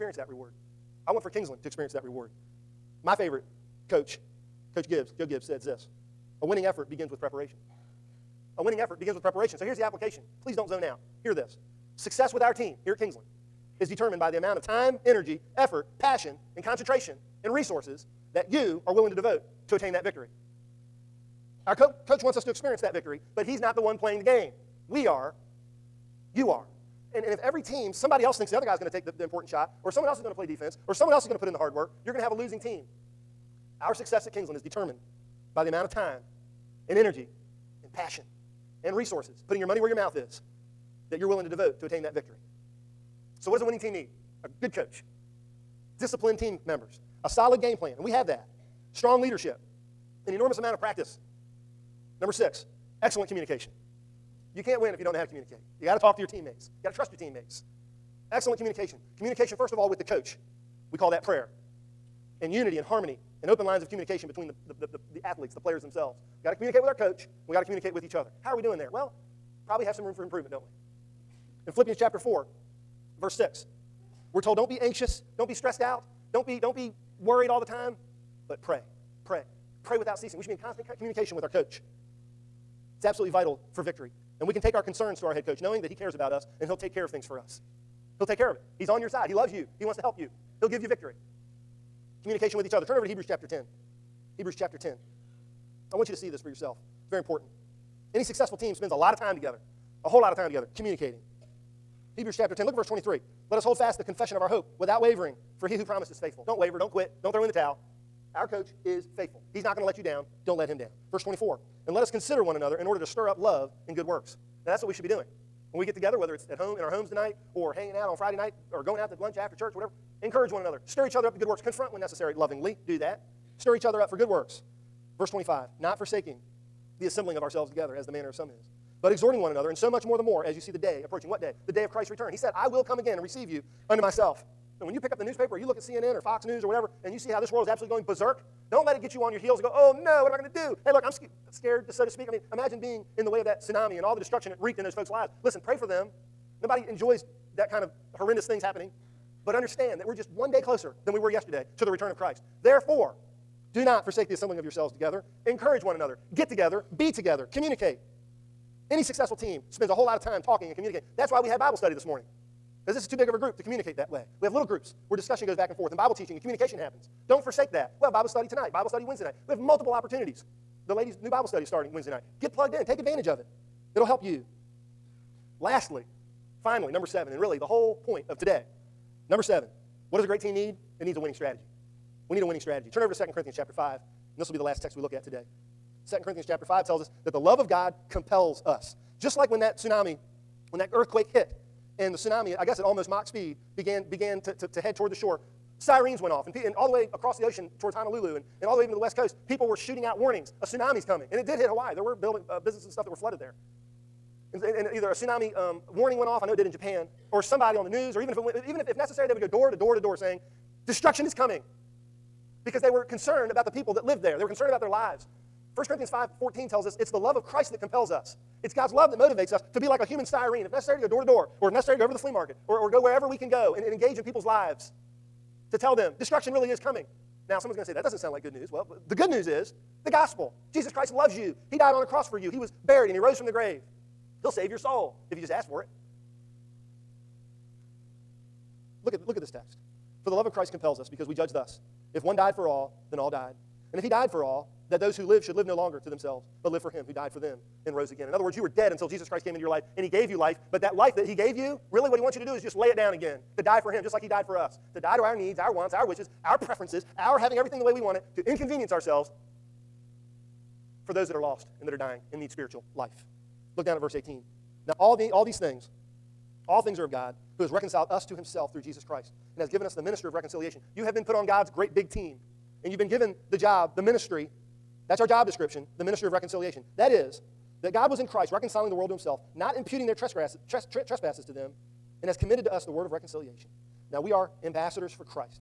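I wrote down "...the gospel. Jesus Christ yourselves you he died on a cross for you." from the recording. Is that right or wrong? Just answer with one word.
wrong.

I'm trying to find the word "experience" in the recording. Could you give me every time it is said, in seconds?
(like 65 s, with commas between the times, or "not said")
1 s, 22 s.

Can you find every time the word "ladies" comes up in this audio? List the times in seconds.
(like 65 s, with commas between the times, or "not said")
170 s.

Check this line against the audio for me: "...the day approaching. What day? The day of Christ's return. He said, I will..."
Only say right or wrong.
right.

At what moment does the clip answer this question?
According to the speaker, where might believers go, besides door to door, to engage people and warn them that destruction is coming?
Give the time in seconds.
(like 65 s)
222 s.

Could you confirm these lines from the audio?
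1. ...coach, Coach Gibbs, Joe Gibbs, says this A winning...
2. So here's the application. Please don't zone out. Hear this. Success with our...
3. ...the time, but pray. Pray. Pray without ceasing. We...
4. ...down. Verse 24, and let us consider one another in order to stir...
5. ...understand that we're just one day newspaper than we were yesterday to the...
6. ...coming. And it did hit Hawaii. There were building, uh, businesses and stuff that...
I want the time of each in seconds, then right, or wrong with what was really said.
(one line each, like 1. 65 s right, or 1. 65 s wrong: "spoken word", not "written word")
1. 3 s right
2. 9 s right
3. 77 s right
4. 110 s right
5. 149 s wrong: "closer", not "newspaper"
6. 201 s right.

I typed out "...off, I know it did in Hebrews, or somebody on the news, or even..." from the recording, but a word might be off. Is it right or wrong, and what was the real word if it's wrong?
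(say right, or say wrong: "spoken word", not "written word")
wrong: "Japan", not "Hebrews".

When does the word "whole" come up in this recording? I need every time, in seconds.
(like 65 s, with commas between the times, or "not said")
100 s, 159 s, 177 s.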